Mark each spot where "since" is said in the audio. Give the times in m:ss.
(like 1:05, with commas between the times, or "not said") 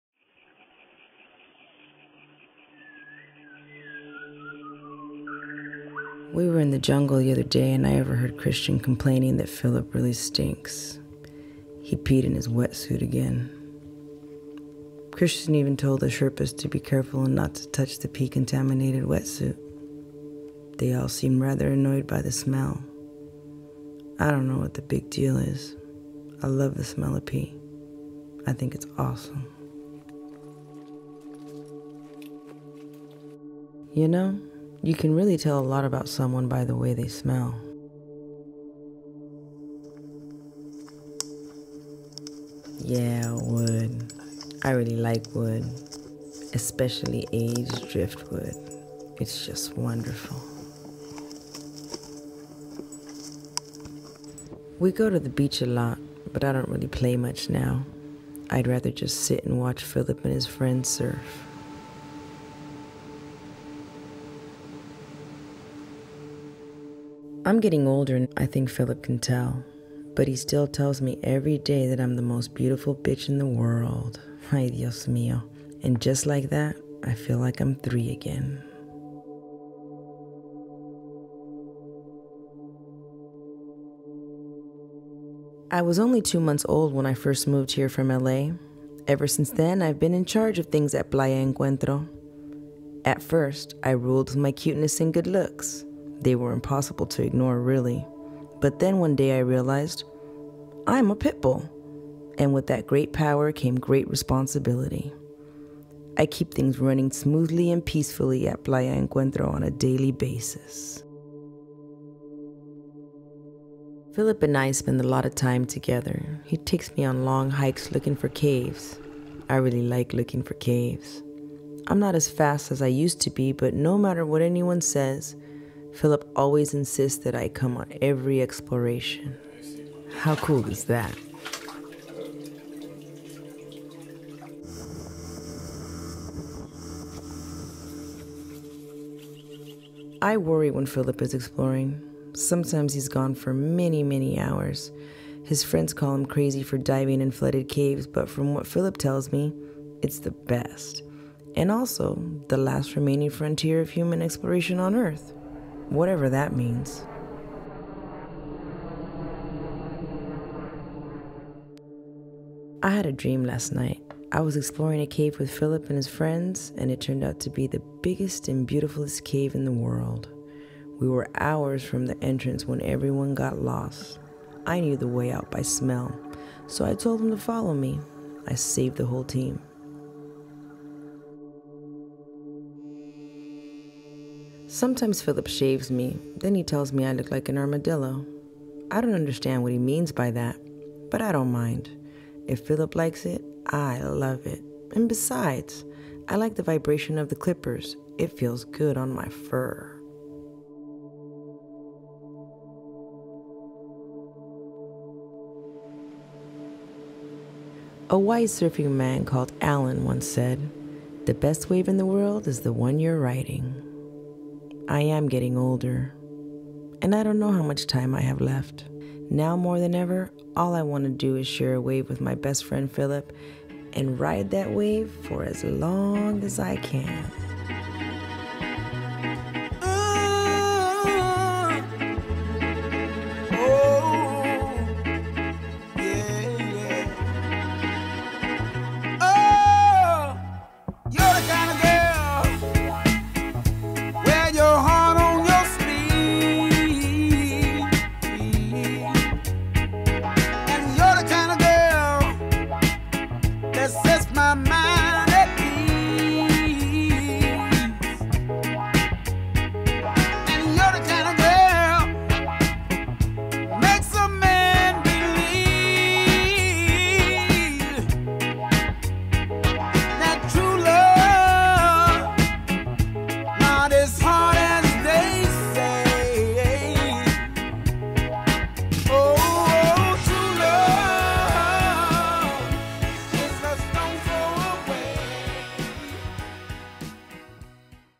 1:29.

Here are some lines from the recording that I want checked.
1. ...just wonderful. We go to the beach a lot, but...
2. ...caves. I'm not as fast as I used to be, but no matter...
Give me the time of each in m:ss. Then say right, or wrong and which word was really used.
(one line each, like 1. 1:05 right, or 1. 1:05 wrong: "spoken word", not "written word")
1. 0:49 right
2. 2:00 right.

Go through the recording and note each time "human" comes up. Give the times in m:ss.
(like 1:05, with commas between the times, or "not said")
2:33.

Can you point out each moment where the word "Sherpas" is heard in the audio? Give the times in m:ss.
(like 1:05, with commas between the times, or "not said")
0:16.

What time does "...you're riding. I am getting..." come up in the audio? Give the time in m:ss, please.
3:33.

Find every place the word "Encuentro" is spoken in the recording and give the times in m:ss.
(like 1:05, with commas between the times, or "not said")
1:31, 1:48.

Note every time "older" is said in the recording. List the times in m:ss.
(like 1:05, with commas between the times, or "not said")
1:07, 3:35.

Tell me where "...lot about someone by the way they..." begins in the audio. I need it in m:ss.
0:35.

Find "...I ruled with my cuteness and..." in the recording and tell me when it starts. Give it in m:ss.
1:33.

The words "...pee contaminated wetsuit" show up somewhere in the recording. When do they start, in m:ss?
0:18.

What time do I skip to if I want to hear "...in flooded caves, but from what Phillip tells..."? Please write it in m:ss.
2:27.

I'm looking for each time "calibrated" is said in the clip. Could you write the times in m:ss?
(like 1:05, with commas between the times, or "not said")
not said.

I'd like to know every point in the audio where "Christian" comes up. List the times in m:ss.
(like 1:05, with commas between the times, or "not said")
0:08, 0:15.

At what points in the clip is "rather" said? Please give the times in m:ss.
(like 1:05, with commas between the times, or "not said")
0:21, 0:58.